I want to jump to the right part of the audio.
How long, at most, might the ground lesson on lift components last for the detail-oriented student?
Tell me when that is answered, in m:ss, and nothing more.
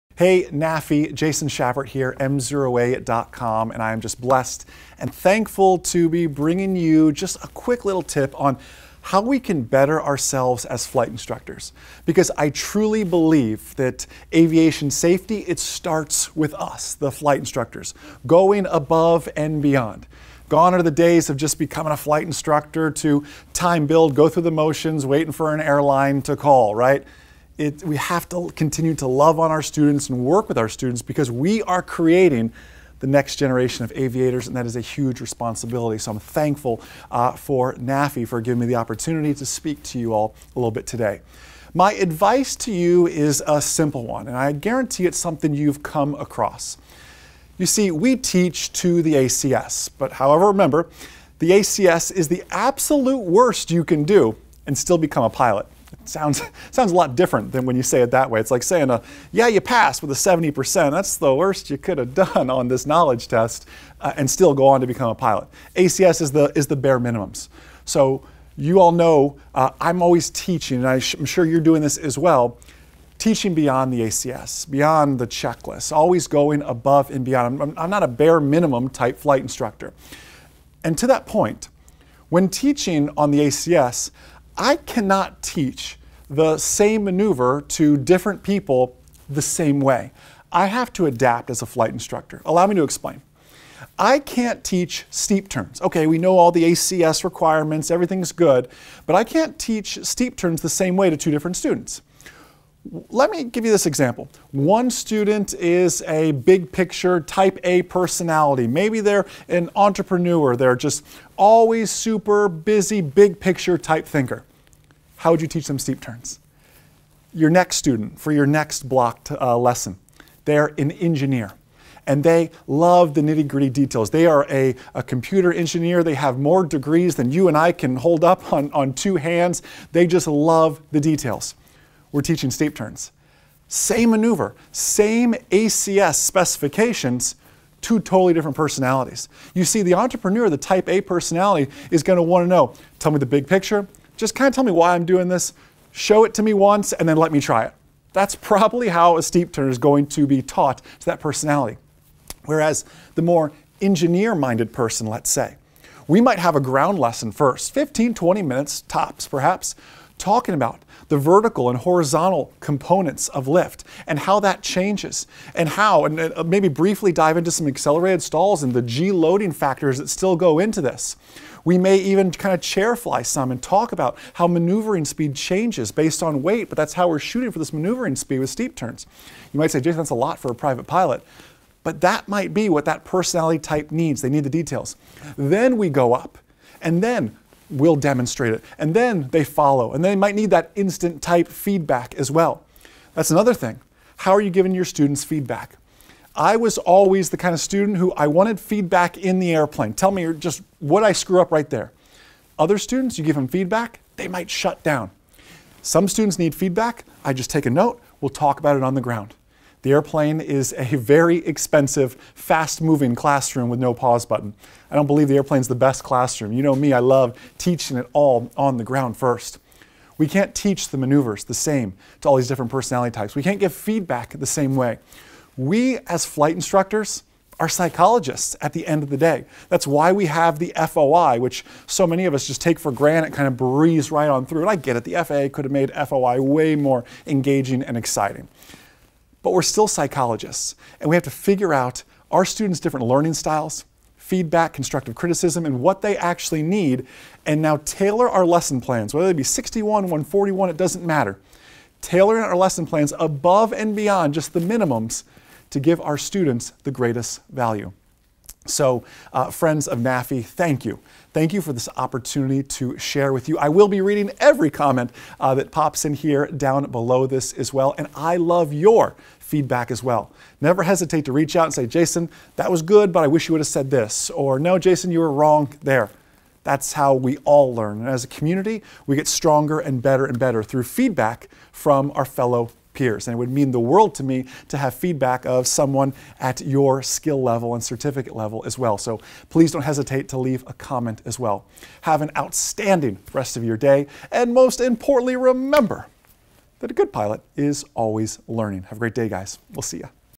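2:37.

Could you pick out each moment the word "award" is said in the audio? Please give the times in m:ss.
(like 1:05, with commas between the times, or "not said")
not said.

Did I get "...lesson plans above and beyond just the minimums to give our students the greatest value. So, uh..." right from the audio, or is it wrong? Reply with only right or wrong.
right.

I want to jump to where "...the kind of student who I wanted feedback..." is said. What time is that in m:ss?
3:17.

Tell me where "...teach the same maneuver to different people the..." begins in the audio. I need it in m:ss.
1:25.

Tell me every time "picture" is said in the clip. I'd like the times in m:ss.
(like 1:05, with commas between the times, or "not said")
1:46, 1:53, 2:23.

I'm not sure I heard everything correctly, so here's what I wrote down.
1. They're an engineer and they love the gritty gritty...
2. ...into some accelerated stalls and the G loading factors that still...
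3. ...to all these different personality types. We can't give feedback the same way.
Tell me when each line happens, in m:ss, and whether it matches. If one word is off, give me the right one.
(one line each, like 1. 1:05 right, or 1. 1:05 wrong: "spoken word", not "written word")
1. 2:00 wrong: "nitty", not "gritty"
2. 2:47 right
3. 3:42 right.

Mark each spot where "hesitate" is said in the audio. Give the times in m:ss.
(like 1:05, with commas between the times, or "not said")
4:30, 4:49.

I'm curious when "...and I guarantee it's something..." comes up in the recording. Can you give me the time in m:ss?
0:44.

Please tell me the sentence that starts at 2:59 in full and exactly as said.
You might say, Jason, that's a lot for a private pilot.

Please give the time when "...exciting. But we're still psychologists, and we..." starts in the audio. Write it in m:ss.
3:57.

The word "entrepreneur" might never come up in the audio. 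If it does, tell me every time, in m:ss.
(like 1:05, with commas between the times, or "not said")
1:49, 2:19.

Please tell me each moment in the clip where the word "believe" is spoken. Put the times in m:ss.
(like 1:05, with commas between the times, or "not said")
0:13, 3:35.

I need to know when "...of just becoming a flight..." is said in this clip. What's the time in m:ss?
0:21.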